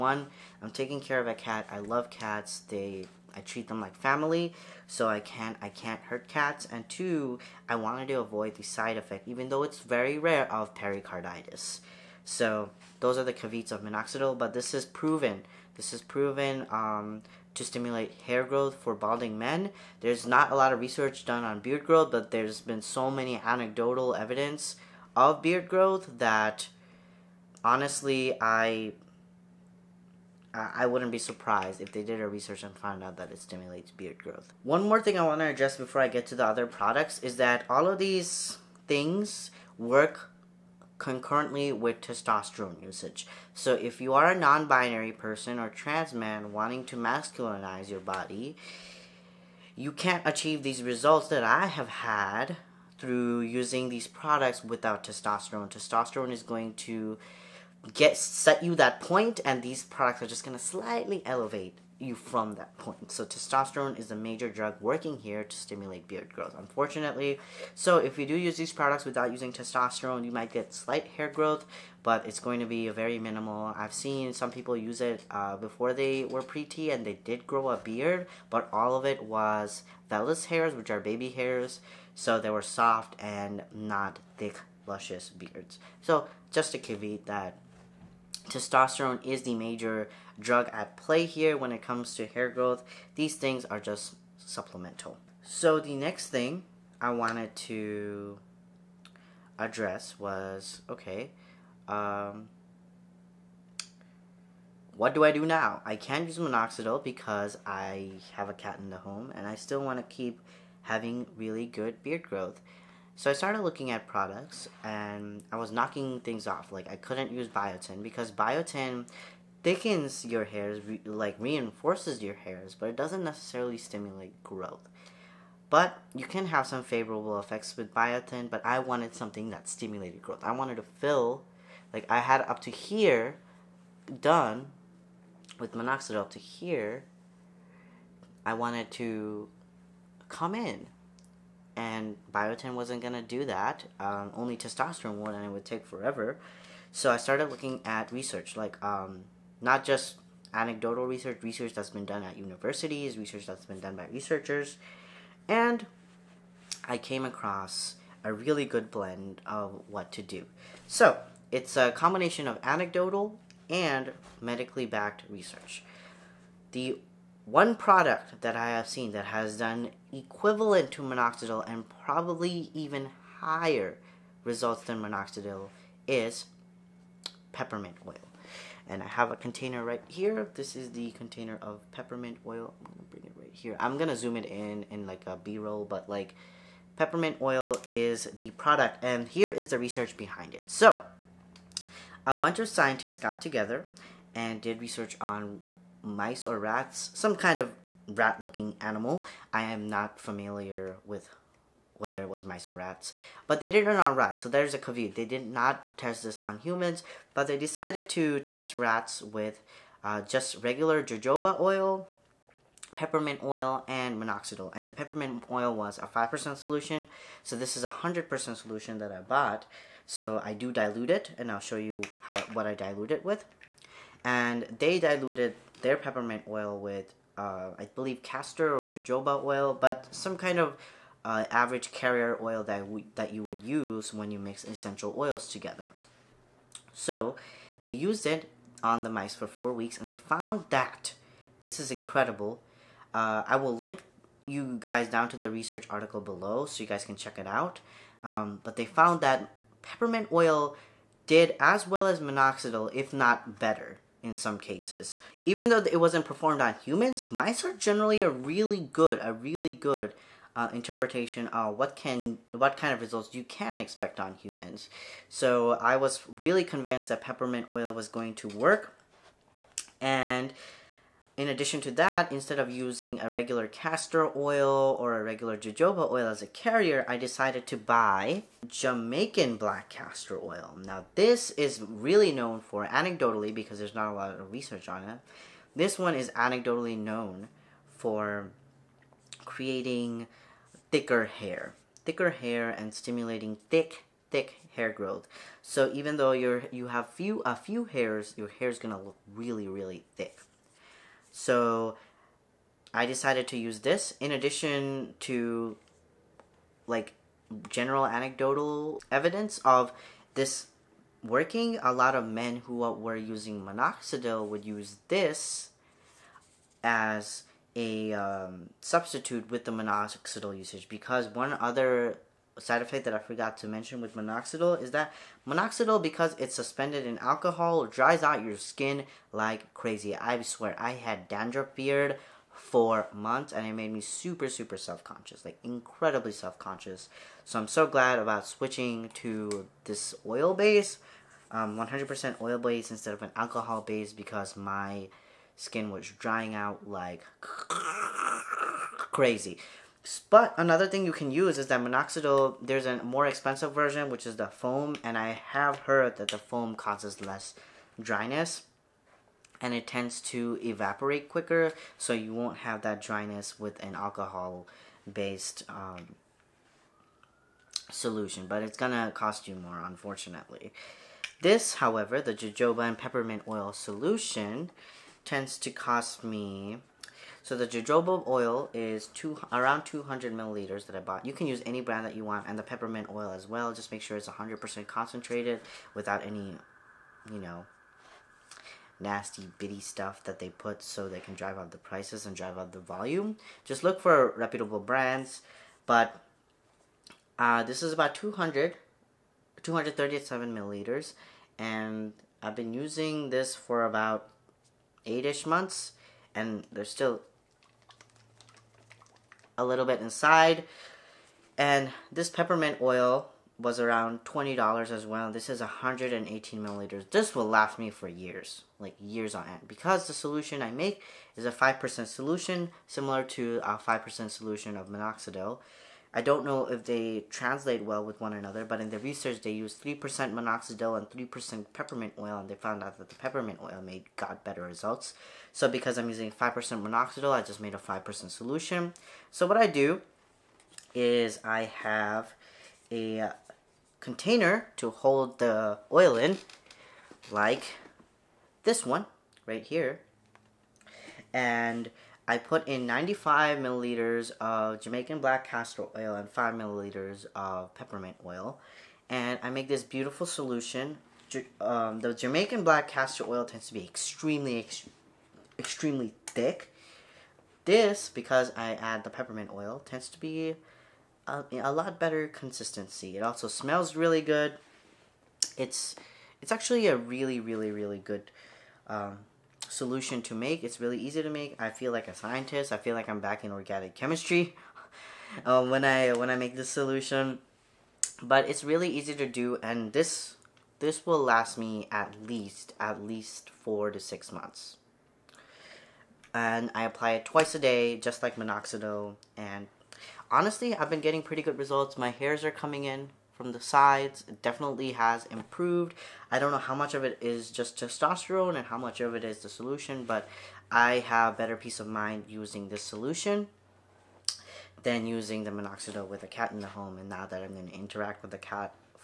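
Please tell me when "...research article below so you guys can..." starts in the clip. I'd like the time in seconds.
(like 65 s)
245 s.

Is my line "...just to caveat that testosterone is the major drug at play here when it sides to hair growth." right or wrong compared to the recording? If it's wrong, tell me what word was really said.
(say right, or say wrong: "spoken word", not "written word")
wrong: "comes", not "sides".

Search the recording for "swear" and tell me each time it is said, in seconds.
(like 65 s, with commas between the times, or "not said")
330 s.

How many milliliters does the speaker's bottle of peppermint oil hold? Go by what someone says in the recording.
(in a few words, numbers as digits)
118.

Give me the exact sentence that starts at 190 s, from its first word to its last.
So, a bunch of scientists got together and did research on mice or rats, some kind of rat looking animal.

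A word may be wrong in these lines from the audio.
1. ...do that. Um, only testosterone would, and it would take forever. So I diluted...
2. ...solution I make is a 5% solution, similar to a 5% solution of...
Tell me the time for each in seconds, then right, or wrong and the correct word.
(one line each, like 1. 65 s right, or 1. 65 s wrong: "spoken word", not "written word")
1. 143 s wrong: "started", not "diluted"
2. 420 s right.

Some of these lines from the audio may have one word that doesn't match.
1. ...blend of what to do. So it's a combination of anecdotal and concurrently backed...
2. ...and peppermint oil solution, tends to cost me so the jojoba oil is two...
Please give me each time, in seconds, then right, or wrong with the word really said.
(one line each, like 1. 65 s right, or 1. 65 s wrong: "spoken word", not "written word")
1. 158 s wrong: "medically", not "concurrently"
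2. 372 s right.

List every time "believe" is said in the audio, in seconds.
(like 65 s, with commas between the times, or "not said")
227 s.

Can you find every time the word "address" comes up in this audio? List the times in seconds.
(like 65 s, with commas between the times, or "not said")
35 s, 99 s.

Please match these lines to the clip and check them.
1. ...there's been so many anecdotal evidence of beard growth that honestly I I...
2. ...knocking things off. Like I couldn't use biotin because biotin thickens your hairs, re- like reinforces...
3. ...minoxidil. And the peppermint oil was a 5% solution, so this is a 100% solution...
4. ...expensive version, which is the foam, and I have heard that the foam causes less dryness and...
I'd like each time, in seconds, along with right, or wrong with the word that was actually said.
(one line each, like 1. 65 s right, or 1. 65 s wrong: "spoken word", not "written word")
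1. 22 s right
2. 115 s right
3. 214 s right
4. 353 s right.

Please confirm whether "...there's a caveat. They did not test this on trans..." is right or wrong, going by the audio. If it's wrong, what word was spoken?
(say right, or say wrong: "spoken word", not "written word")
wrong: "humans", not "trans".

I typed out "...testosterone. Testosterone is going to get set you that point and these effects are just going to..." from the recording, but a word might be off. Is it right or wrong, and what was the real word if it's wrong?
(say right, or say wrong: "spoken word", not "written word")
wrong: "products", not "effects".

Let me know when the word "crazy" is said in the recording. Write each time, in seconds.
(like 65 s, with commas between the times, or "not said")
329 s, 347 s.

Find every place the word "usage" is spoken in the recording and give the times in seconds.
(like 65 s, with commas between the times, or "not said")
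42 s, 320 s.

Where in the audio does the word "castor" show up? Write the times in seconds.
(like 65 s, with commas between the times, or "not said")
228 s, 273 s, 279 s, 455 s, 462 s.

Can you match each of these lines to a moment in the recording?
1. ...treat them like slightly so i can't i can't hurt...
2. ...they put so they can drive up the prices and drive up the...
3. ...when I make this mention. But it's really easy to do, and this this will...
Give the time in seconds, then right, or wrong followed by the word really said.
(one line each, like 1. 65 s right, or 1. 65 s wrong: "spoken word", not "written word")
1. 3 s wrong: "family", not "slightly"
2. 390 s right
3. 486 s wrong: "solution", not "mention".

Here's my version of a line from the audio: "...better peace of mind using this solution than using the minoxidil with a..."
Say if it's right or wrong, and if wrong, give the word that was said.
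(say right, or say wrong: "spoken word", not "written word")
right.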